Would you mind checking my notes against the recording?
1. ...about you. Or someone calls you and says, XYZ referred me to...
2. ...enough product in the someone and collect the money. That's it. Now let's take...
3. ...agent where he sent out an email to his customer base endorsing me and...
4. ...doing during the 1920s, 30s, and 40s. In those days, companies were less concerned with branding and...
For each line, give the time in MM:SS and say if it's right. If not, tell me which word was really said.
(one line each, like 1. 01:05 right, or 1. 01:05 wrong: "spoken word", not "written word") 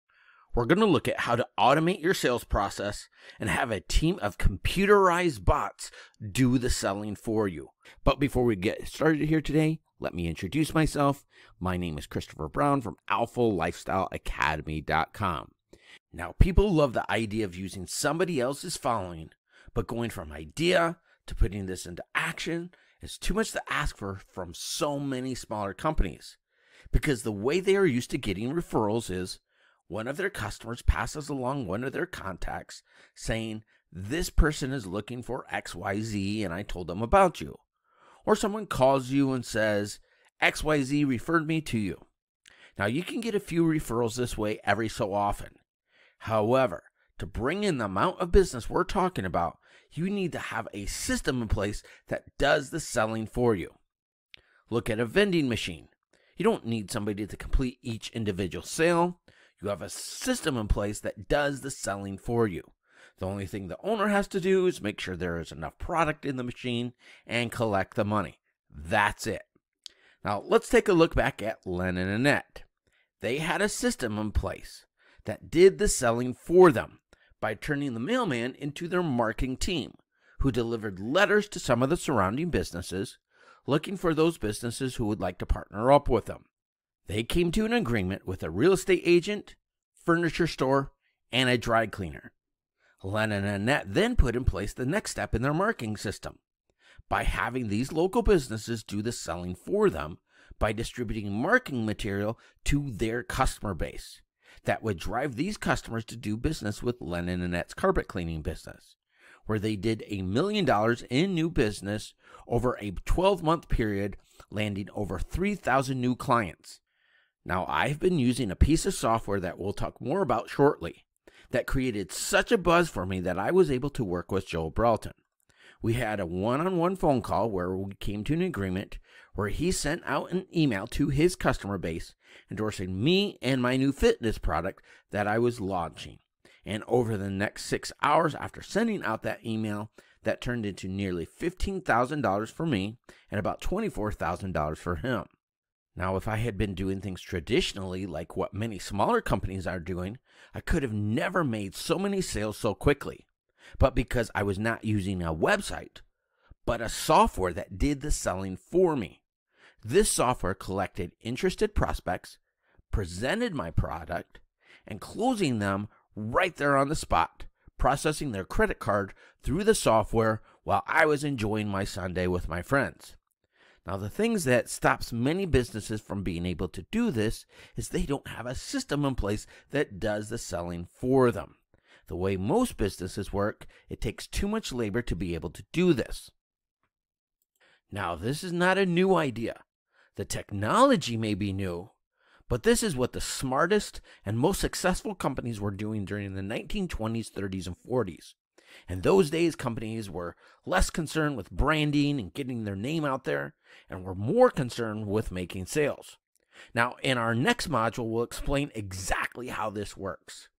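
1. 00:37 right
2. 01:05 wrong: "machine", not "someone"
3. 02:08 wrong: "agreement", not "agent"
4. 03:15 right.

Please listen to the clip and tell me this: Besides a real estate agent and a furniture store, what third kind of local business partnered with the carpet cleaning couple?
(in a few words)
dry cleaner.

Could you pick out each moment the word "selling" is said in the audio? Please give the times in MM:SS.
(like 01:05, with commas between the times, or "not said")
00:06, 00:52, 01:01, 01:15, 01:39, 02:38, 03:00.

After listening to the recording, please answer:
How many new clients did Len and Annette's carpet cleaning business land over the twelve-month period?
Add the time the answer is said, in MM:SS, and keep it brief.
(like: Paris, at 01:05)
over 3,000, at 01:54.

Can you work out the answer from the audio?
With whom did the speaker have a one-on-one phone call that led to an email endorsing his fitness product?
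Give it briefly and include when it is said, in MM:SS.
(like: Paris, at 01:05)
Joel Broughton, at 02:04.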